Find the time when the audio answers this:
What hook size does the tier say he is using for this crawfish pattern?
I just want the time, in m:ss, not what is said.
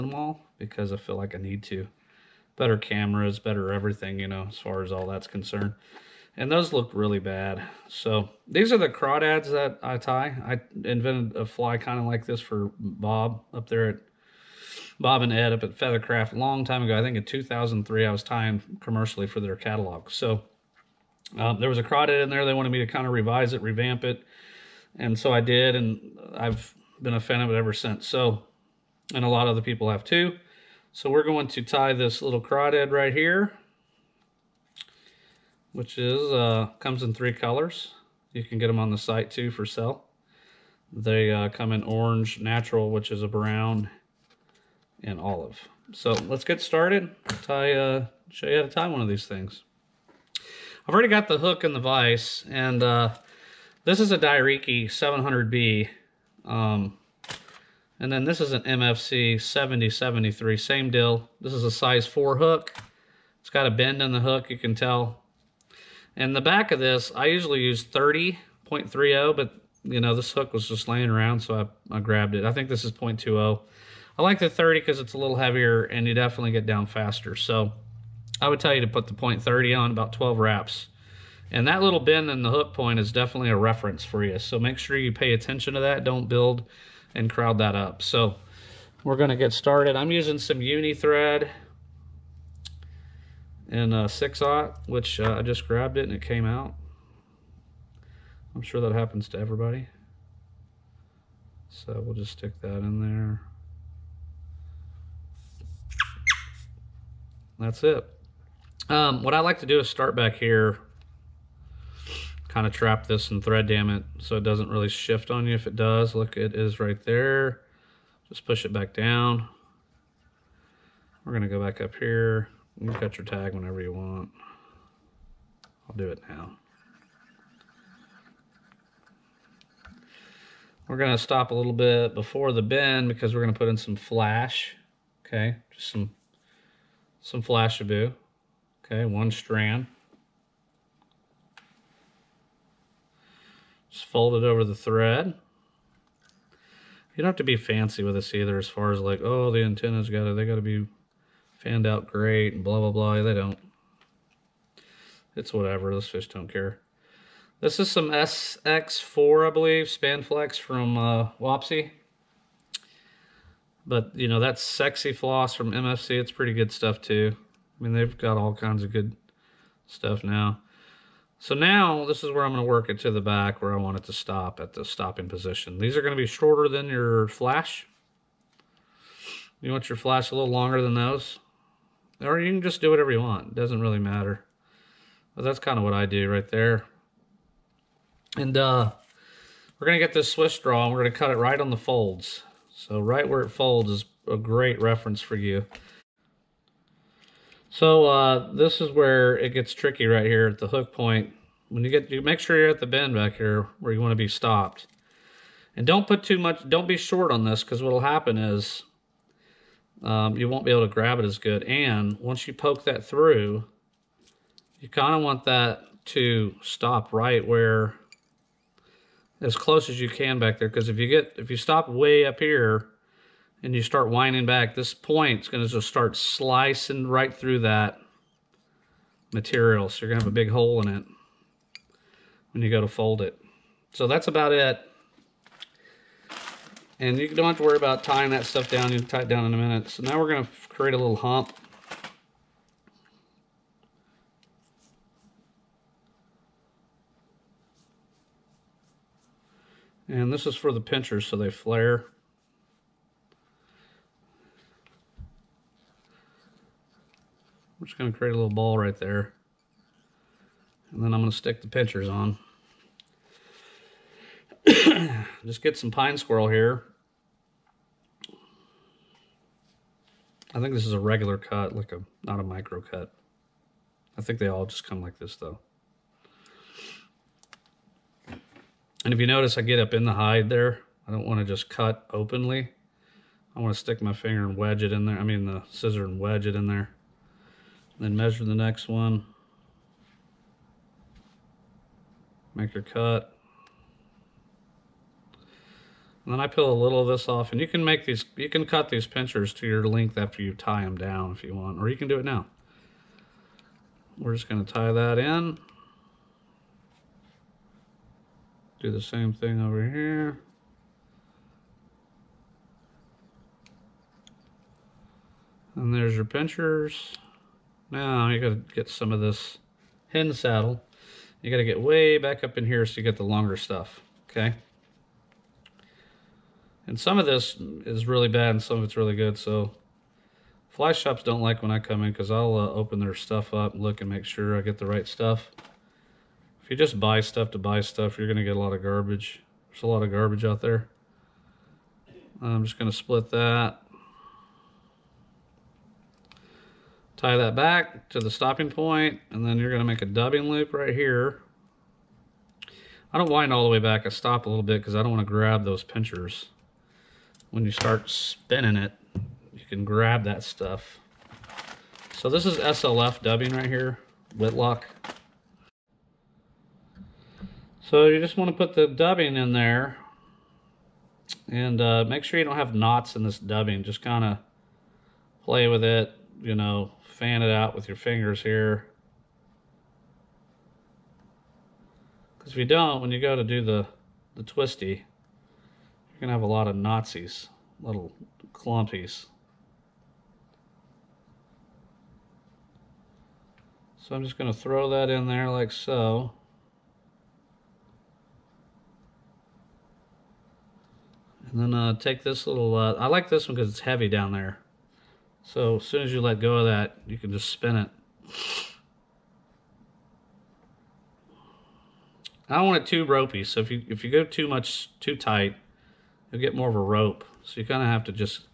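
1:01.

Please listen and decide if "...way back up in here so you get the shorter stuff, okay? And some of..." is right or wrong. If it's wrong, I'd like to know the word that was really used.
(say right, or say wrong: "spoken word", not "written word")
wrong: "longer", not "shorter".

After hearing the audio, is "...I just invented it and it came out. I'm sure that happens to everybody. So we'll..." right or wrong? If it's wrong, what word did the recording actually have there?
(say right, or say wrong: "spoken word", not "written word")
wrong: "grabbed", not "invented".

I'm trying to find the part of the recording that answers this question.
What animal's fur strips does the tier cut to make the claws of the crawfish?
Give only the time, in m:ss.
4:25.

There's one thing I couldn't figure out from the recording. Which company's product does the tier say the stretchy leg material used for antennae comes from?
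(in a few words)
Wapsi.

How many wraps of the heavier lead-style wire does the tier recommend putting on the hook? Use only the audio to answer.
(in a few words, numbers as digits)
12.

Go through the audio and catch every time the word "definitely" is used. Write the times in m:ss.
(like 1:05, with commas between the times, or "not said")
1:16, 1:23.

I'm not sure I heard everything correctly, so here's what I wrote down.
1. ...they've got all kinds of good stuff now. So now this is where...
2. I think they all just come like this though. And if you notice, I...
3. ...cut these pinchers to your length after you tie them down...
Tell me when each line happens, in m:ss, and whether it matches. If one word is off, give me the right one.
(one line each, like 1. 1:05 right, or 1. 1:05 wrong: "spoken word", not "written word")
1. 2:47 right
2. 4:34 right
3. 4:58 right.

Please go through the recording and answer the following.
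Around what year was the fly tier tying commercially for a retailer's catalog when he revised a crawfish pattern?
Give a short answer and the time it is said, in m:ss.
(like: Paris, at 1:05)
2003, at 0:17.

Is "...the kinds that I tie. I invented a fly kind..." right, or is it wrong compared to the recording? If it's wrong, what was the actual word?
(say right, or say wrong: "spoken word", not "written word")
wrong: "crawdads", not "kinds".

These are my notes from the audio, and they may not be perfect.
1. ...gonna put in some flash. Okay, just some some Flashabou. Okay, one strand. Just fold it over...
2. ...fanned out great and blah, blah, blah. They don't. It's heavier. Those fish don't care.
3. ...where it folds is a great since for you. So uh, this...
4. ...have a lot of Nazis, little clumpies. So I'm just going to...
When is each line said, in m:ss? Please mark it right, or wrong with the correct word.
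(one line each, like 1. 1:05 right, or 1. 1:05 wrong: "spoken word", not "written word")
1. 2:13 right
2. 2:31 wrong: "whatever", not "heavier"
3. 3:13 wrong: "reference", not "since"
4. 6:26 right.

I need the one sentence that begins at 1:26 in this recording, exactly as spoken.
Don't build and crowd that up.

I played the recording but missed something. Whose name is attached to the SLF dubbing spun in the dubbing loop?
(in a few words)
Whitlock.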